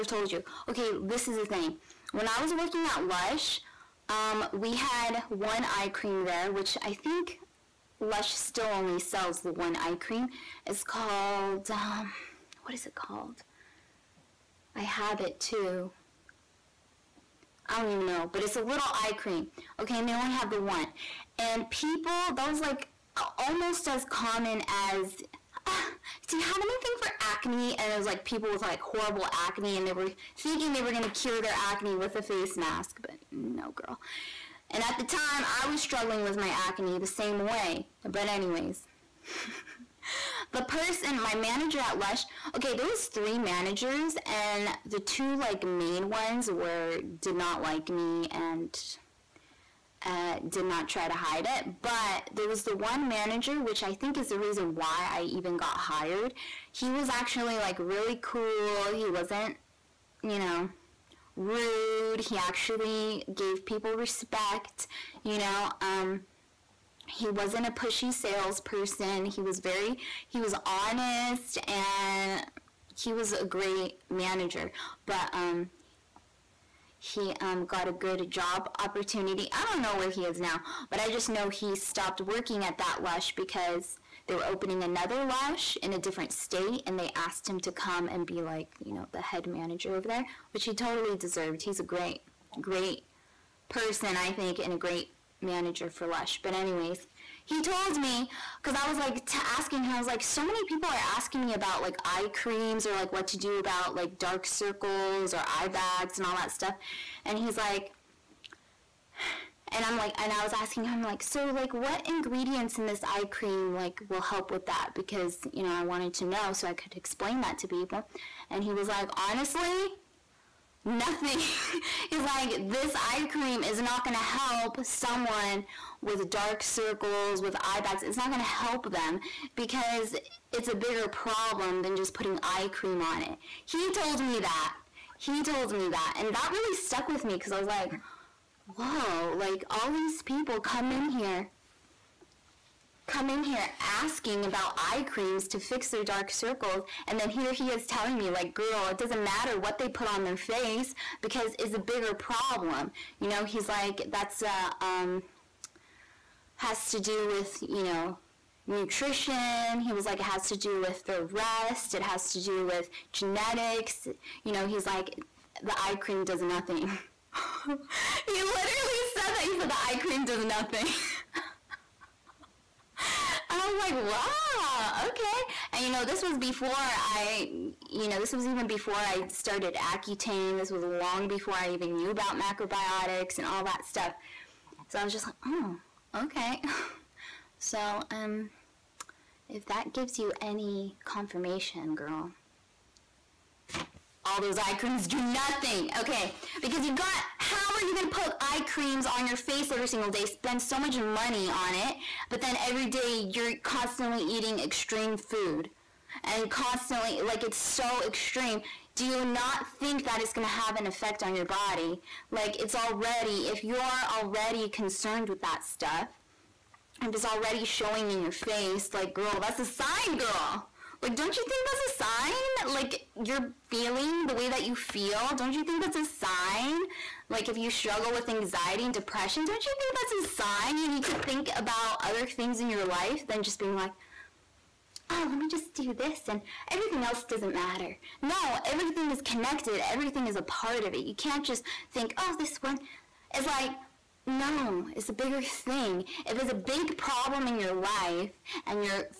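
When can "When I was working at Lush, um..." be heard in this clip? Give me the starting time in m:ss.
0:02.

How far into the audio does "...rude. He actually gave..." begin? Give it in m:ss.
1:01.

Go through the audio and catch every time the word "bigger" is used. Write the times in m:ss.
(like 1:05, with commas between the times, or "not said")
2:10, 2:31, 4:05.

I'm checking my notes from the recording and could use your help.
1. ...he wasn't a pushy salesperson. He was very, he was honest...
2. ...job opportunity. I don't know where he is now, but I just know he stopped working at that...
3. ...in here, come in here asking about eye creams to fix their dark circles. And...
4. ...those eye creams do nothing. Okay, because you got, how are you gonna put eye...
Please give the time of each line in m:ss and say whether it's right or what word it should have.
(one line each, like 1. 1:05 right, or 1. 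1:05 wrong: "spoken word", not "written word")
1. 1:07 right
2. 1:18 right
3. 2:20 right
4. 3:14 right.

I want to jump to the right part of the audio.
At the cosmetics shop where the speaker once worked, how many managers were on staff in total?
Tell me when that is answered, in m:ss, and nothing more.
0:43.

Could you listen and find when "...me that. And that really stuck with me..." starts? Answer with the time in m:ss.
2:15.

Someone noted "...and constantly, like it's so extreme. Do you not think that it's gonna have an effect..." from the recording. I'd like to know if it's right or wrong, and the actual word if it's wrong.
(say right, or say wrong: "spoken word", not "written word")
right.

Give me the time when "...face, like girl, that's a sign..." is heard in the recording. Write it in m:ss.
3:38.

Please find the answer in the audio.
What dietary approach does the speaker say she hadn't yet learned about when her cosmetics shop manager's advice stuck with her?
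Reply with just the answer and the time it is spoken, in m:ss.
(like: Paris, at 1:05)
macrobiotics, at 3:02.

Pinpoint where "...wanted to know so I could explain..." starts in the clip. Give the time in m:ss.
1:55.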